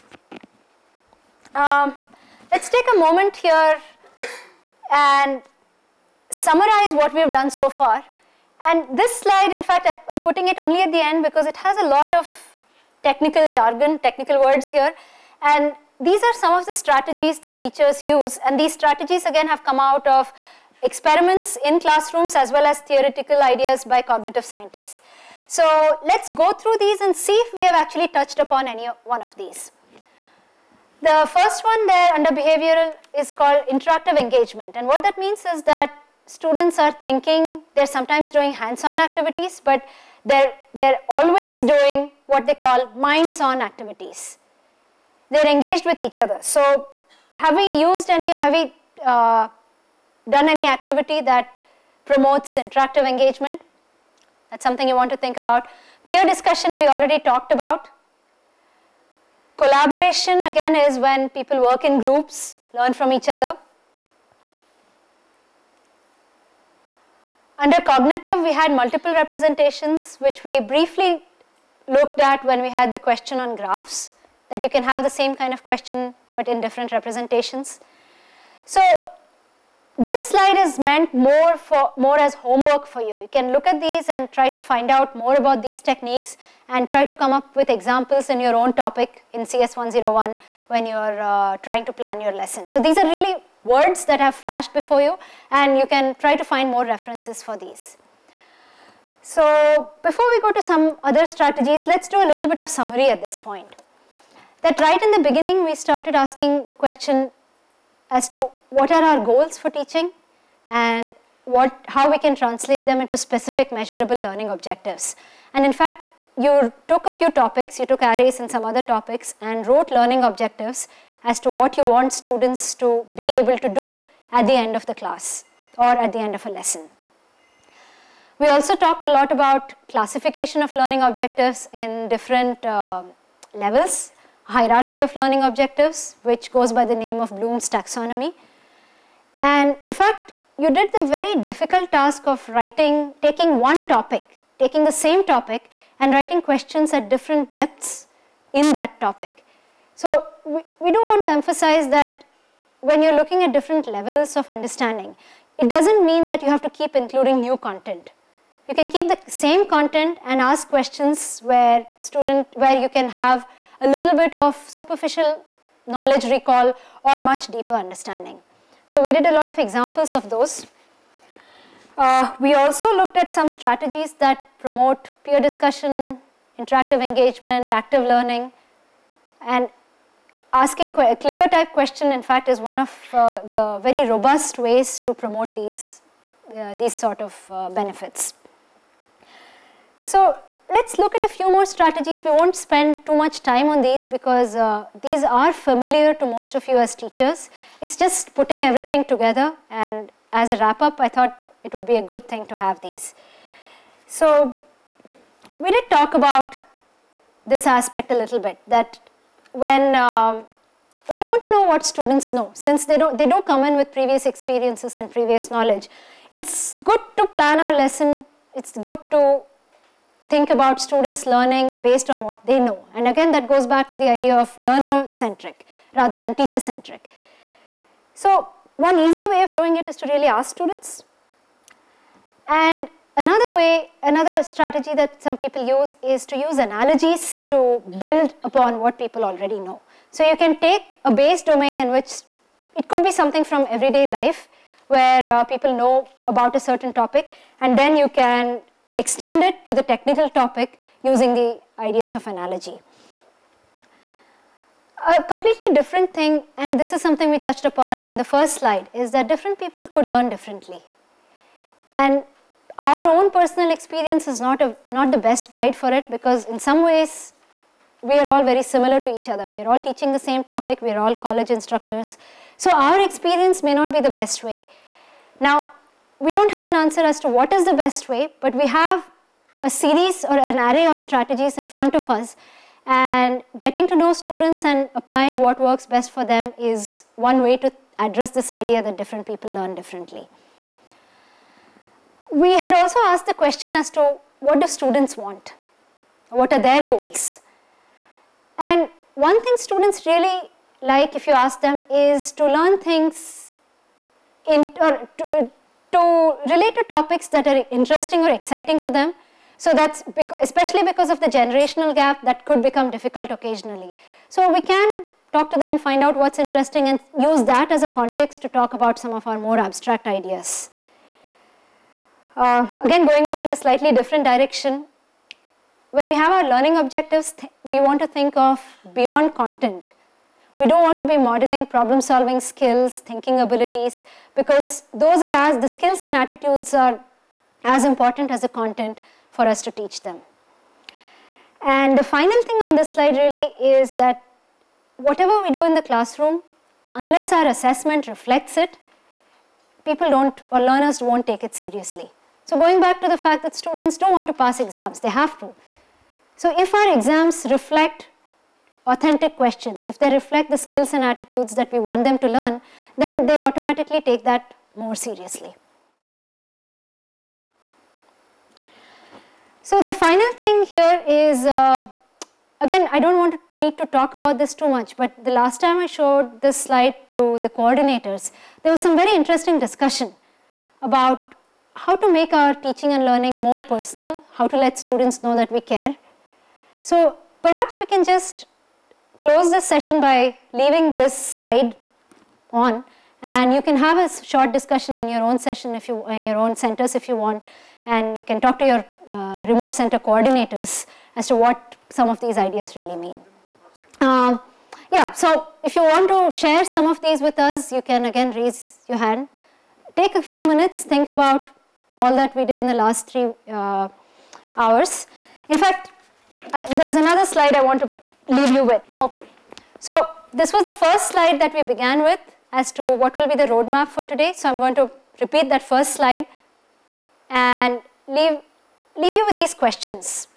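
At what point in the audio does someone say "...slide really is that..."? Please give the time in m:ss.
5:42.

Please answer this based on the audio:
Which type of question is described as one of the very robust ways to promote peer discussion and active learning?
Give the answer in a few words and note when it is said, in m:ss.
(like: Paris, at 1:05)
Clicker type question, at 3:00.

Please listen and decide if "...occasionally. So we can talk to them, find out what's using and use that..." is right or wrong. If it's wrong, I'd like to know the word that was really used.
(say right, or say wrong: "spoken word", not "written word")
wrong: "interesting", not "using".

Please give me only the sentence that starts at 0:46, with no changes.
So have we used any, have we uh, done any activity that promotes interactive engagement?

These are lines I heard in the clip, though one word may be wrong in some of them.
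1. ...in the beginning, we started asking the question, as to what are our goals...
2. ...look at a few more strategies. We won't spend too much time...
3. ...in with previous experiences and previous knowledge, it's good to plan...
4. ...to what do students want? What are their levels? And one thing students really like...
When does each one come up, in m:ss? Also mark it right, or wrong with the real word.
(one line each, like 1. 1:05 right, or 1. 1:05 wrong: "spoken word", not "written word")
1. 1:45 right
2. 3:10 right
3. 3:33 right
4. 4:53 wrong: "goals", not "levels".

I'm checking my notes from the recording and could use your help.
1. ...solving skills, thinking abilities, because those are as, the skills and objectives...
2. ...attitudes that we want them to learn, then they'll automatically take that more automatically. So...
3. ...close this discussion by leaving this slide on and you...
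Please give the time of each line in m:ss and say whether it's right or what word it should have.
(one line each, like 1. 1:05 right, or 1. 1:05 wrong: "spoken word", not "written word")
1. 5:32 wrong: "attitudes", not "objectives"
2. 6:01 wrong: "seriously", not "automatically"
3. 6:29 wrong: "session", not "discussion".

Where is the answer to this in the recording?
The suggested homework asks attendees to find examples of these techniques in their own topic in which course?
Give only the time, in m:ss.
1:29.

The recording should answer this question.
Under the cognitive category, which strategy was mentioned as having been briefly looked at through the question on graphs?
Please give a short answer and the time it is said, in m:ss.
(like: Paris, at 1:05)
Multiple representations, at 1:08.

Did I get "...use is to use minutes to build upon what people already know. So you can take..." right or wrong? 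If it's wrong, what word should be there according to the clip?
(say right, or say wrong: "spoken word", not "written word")
wrong: "analogies", not "minutes".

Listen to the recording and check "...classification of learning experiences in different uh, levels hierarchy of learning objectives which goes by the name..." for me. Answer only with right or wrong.
wrong.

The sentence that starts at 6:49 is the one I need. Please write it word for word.
Take a few minutes, think about all that we did in the last three uh, hours.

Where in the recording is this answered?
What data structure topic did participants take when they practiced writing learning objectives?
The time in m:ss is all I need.
1:58.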